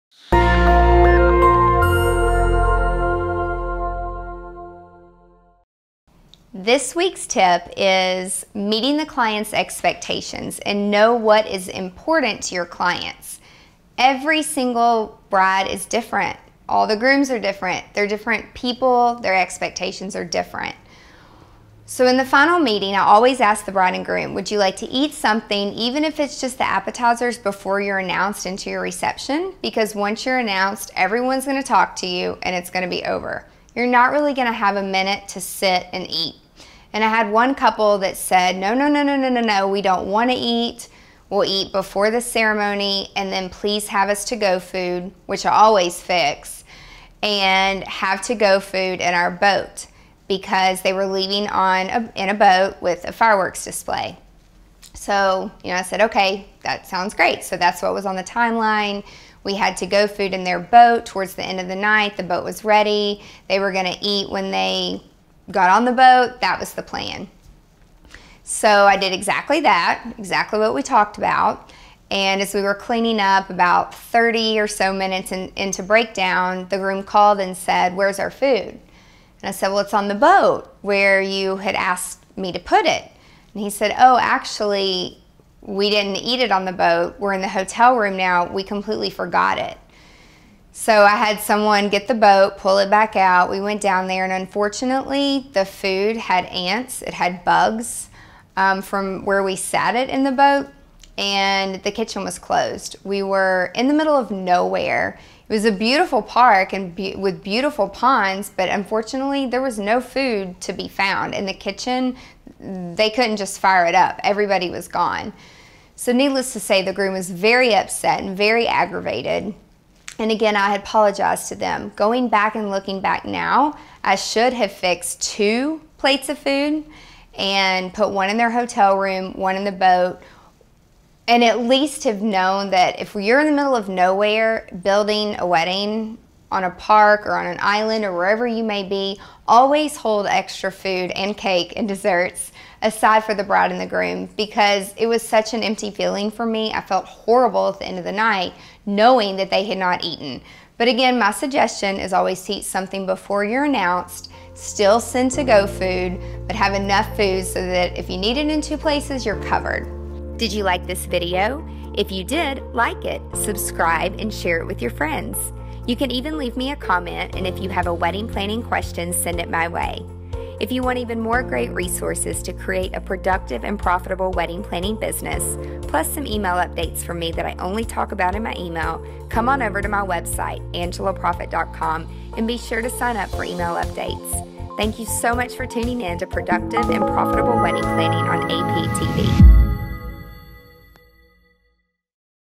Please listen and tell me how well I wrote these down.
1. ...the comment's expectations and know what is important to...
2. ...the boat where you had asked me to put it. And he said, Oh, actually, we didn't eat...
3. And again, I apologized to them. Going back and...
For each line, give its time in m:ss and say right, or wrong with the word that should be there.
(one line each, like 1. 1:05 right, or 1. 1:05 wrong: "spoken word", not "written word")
1. 0:08 wrong: "client", not "comment"
2. 1:20 right
3. 2:00 right.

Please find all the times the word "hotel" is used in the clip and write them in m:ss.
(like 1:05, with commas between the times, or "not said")
1:27, 2:08.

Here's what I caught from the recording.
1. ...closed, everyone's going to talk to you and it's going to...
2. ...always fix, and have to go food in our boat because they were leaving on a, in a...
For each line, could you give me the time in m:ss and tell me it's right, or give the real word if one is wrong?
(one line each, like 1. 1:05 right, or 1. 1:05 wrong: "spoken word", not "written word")
1. 0:30 wrong: "announced", not "closed"
2. 0:45 right.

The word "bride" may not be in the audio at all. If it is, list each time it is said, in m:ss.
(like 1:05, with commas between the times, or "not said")
0:15, 0:23, 2:23.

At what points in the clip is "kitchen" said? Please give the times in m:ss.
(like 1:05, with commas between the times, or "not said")
1:41, 1:51.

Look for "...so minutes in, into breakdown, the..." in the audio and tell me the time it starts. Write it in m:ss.
1:14.